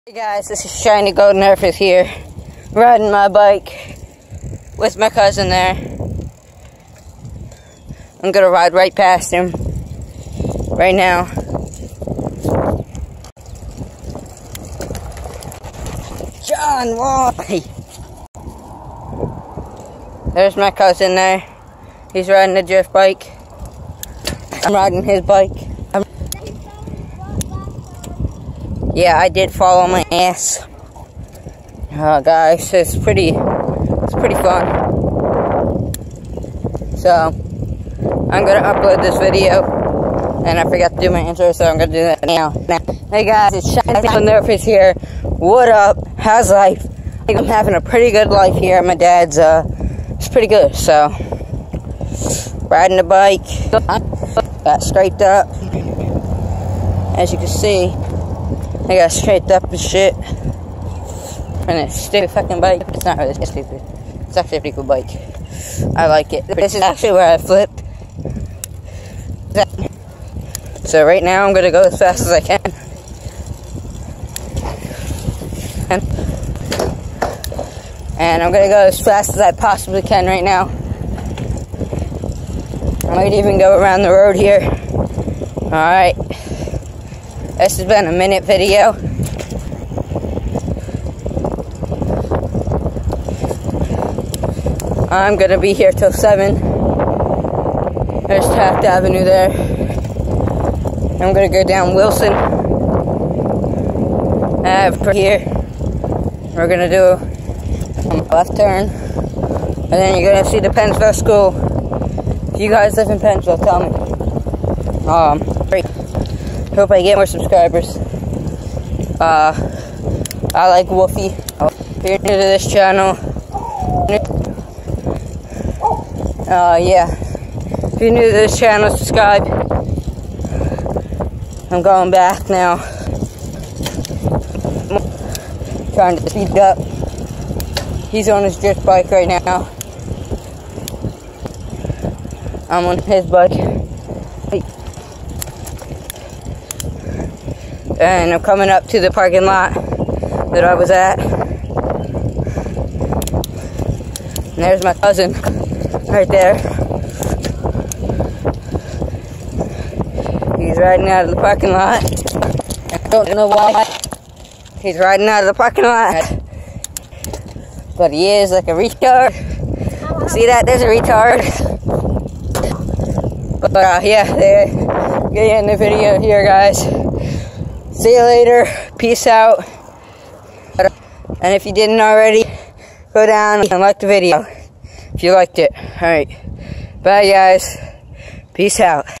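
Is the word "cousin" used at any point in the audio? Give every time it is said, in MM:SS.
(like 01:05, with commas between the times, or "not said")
00:05, 00:20, 02:34.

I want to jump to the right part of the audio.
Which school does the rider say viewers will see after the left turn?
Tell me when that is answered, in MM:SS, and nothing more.
01:50.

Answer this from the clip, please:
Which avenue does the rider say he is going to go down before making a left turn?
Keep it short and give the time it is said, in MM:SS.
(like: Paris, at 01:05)
Wilson Ave, at 01:41.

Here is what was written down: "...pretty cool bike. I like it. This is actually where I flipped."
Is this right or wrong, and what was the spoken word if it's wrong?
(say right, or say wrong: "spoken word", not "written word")
right.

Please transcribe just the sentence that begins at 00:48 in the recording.
My dad's, uh, it's pretty good, so.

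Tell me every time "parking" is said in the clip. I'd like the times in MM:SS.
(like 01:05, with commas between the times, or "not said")
02:29, 02:41, 02:45.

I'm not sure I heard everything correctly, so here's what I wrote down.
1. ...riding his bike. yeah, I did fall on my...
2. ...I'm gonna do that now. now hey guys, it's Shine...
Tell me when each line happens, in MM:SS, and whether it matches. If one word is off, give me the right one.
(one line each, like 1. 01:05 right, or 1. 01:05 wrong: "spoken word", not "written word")
1. 00:24 right
2. 00:41 right.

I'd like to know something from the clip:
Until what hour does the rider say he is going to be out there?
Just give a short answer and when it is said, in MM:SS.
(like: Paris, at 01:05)
7, at 01:36.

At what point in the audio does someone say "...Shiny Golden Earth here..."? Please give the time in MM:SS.
00:00.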